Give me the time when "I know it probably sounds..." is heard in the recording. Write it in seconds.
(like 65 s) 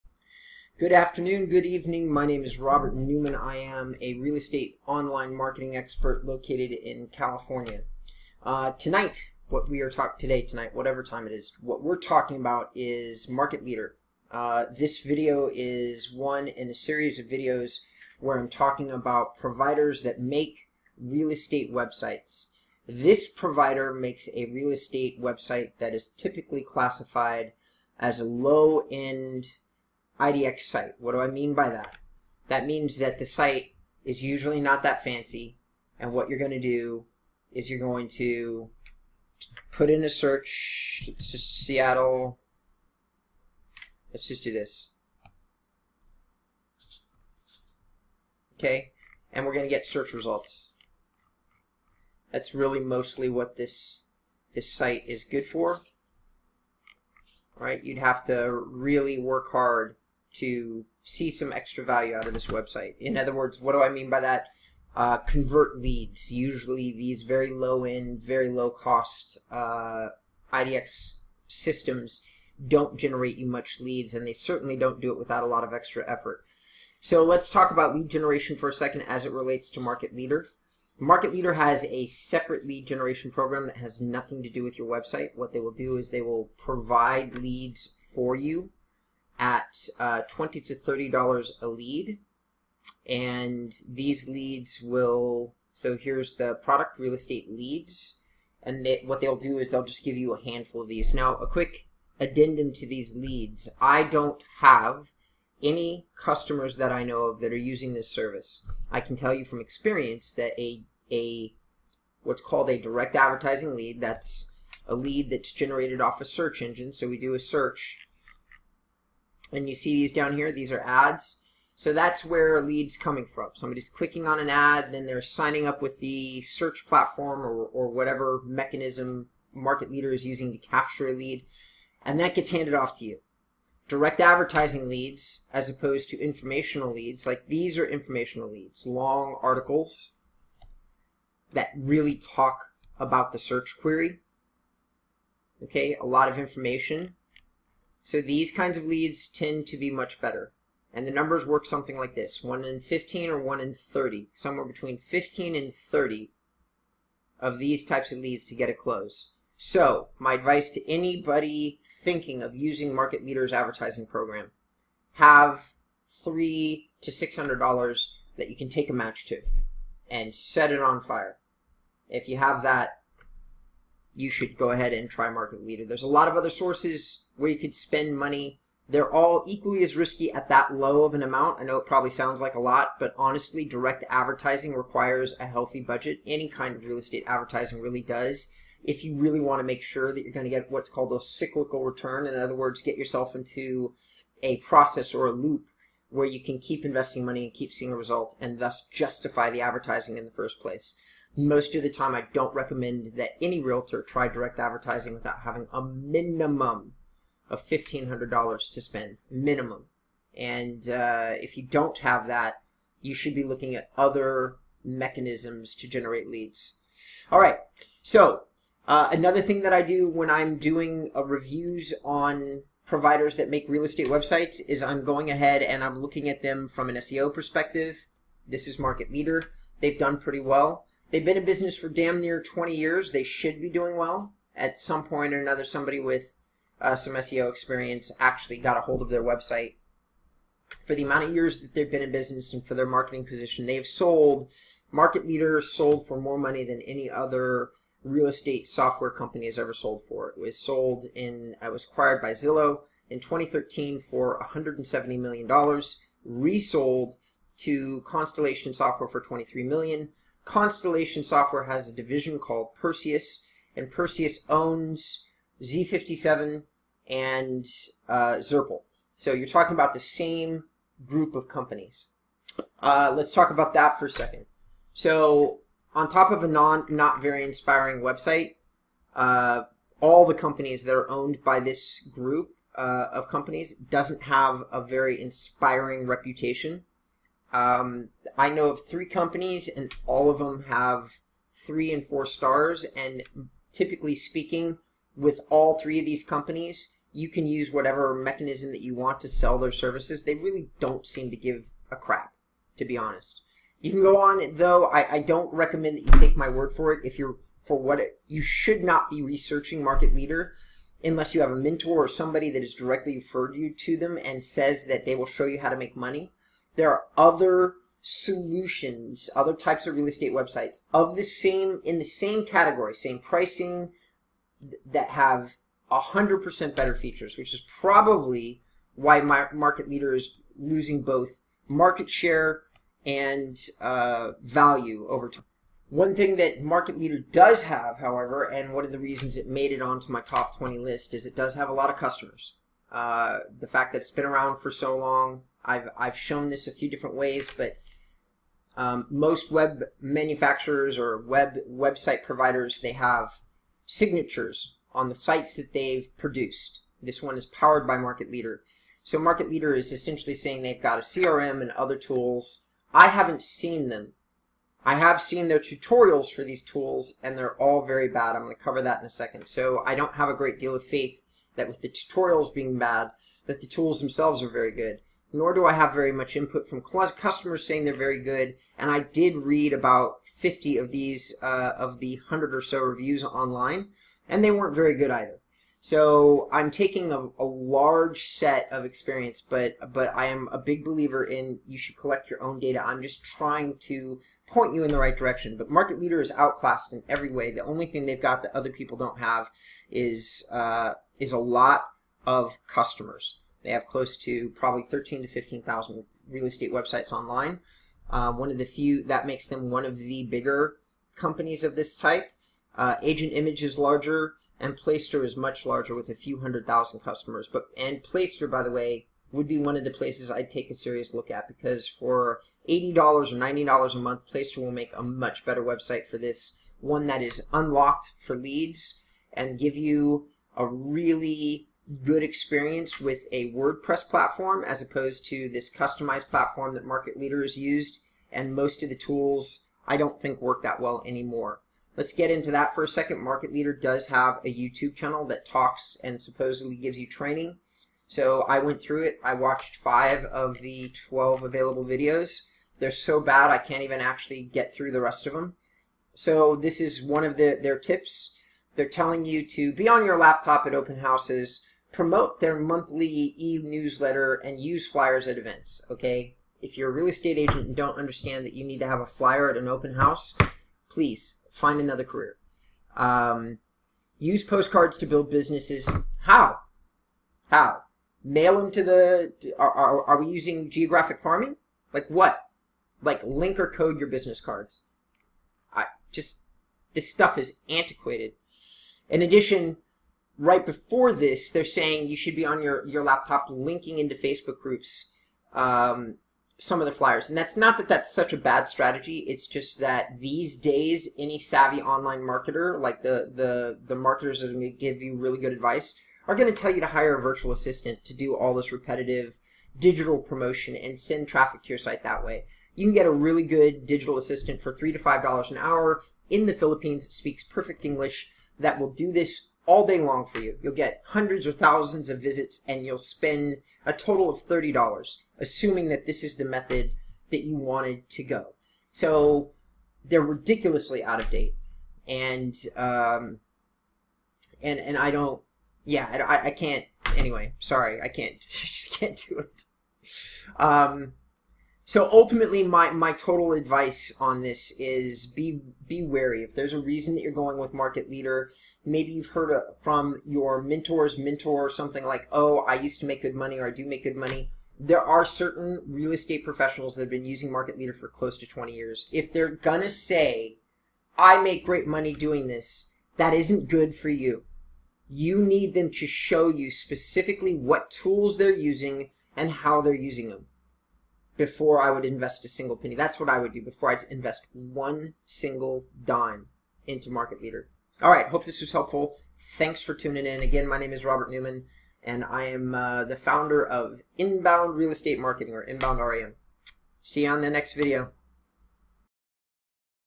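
181 s.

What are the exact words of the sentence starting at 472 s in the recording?
Um, use postcards to build businesses.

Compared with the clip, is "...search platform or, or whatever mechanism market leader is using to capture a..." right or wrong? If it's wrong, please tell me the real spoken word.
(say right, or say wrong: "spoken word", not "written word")
right.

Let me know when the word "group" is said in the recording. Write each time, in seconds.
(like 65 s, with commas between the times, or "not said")
271 s, 282 s, 494 s.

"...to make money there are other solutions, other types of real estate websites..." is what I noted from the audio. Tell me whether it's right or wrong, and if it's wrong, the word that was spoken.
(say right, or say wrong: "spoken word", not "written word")
right.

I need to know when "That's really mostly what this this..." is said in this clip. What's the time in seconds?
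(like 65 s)
52 s.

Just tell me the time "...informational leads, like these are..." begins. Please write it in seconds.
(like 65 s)
136 s.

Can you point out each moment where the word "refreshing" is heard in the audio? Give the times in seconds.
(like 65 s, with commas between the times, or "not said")
not said.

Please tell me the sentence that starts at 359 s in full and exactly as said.
So Market Leader is essentially saying they've got a CRM and other tools.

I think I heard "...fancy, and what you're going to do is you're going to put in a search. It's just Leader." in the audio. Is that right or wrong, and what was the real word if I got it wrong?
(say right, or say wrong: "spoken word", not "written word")
wrong: "Seattle", not "Leader".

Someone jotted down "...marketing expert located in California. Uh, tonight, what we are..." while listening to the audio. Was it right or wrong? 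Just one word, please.
right.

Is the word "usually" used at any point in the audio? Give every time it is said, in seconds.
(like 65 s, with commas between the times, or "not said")
34 s, 66 s.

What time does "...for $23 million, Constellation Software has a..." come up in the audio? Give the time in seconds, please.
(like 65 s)
259 s.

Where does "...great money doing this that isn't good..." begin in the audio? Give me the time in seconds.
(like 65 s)
561 s.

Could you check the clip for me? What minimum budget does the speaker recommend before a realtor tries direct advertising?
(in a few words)
$1,500.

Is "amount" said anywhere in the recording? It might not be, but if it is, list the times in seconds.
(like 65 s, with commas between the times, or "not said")
181 s, 241 s.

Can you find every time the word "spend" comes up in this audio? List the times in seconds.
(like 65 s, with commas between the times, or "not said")
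177 s, 208 s, 522 s.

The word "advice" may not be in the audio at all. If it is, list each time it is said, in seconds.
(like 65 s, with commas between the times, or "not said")
160 s, 505 s, 543 s.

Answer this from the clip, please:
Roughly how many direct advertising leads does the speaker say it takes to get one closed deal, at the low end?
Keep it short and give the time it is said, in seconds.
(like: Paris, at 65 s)
15, at 152 s.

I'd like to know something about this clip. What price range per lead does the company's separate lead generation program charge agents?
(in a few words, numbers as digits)
$20 to $30.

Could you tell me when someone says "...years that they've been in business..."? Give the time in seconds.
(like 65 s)
241 s.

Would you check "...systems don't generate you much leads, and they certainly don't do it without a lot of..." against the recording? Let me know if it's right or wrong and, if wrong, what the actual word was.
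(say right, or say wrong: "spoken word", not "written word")
right.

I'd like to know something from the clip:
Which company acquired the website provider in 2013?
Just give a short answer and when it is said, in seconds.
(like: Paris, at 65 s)
Zillow, at 252 s.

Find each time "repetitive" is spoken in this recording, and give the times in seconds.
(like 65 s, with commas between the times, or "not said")
508 s.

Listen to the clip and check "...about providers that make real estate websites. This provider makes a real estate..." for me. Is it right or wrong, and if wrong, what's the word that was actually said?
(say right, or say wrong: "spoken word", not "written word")
right.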